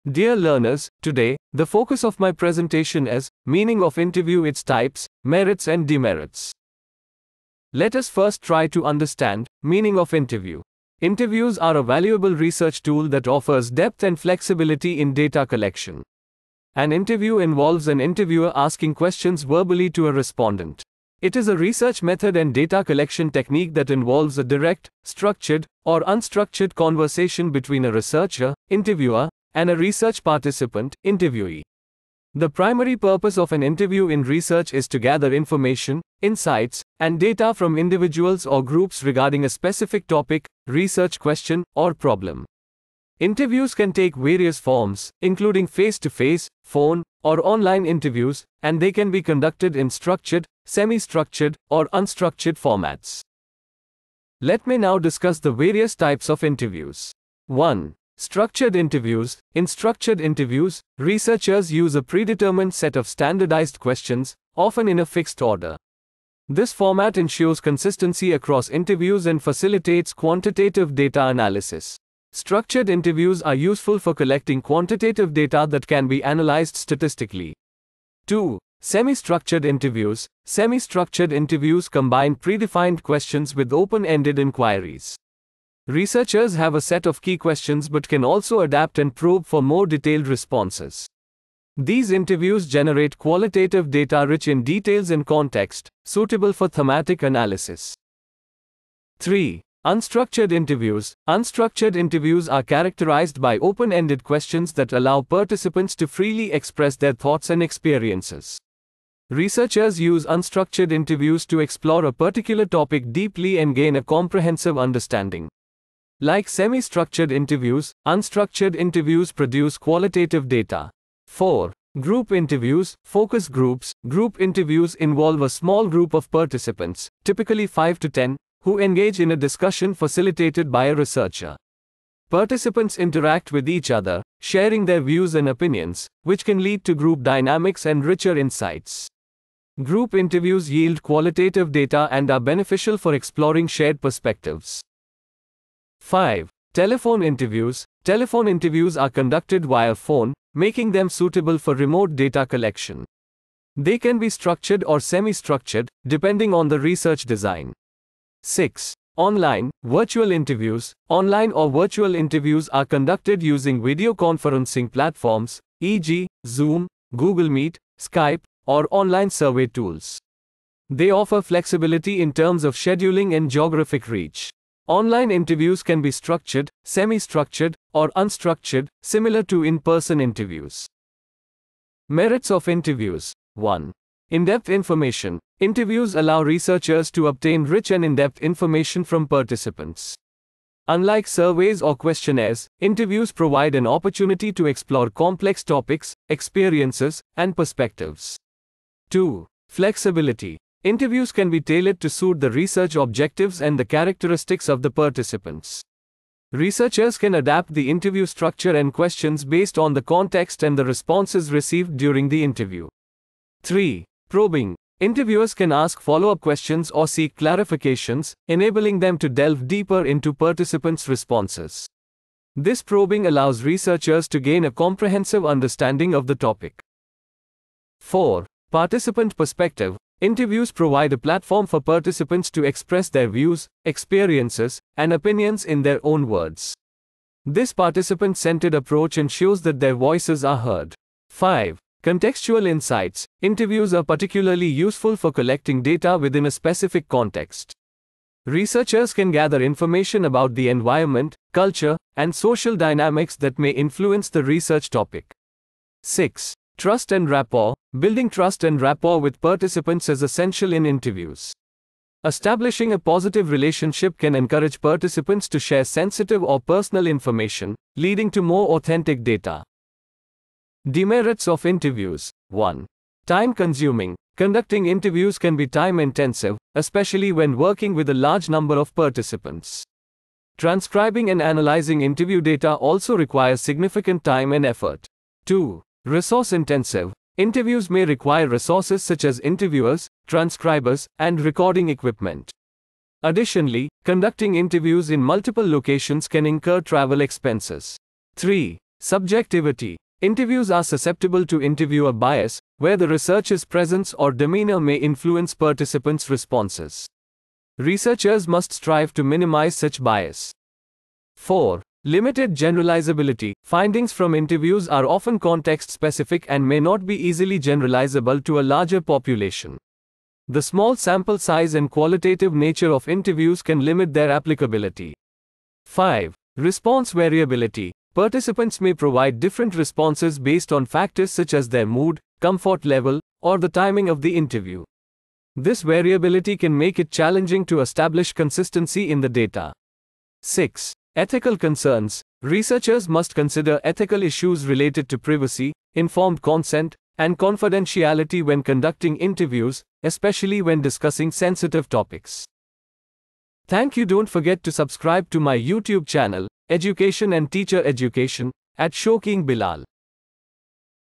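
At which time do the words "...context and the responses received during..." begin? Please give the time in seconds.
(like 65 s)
210 s.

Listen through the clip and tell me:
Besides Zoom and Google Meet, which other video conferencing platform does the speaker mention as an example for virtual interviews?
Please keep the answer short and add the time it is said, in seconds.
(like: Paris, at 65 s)
Skype, at 167 s.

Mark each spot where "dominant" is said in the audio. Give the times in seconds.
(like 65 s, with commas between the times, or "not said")
not said.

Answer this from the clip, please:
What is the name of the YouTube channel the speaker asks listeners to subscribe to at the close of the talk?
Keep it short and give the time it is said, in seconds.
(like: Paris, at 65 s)
Education and Teacher Education, at 356 s.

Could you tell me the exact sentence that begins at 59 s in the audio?
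In structured interviews, researchers use a predetermined set of standardized questions, often in a fixed order.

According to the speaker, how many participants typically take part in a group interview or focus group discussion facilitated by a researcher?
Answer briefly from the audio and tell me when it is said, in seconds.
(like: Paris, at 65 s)
5 to 10, at 127 s.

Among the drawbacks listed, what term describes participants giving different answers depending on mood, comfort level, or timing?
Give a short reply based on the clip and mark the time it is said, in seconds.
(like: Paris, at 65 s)
Response variability, at 326 s.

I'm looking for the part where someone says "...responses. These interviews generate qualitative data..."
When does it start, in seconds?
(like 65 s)
90 s.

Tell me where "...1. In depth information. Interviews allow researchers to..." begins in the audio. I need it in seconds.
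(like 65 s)
183 s.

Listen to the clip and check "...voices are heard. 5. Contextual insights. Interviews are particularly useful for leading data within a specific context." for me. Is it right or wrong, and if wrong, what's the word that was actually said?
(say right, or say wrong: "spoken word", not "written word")
wrong: "collecting", not "leading".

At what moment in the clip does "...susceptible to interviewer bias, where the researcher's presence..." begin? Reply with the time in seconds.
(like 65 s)
300 s.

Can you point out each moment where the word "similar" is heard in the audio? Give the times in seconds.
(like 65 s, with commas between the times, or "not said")
179 s.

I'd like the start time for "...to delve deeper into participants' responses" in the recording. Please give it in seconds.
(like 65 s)
219 s.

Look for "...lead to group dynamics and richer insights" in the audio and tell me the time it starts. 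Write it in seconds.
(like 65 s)
136 s.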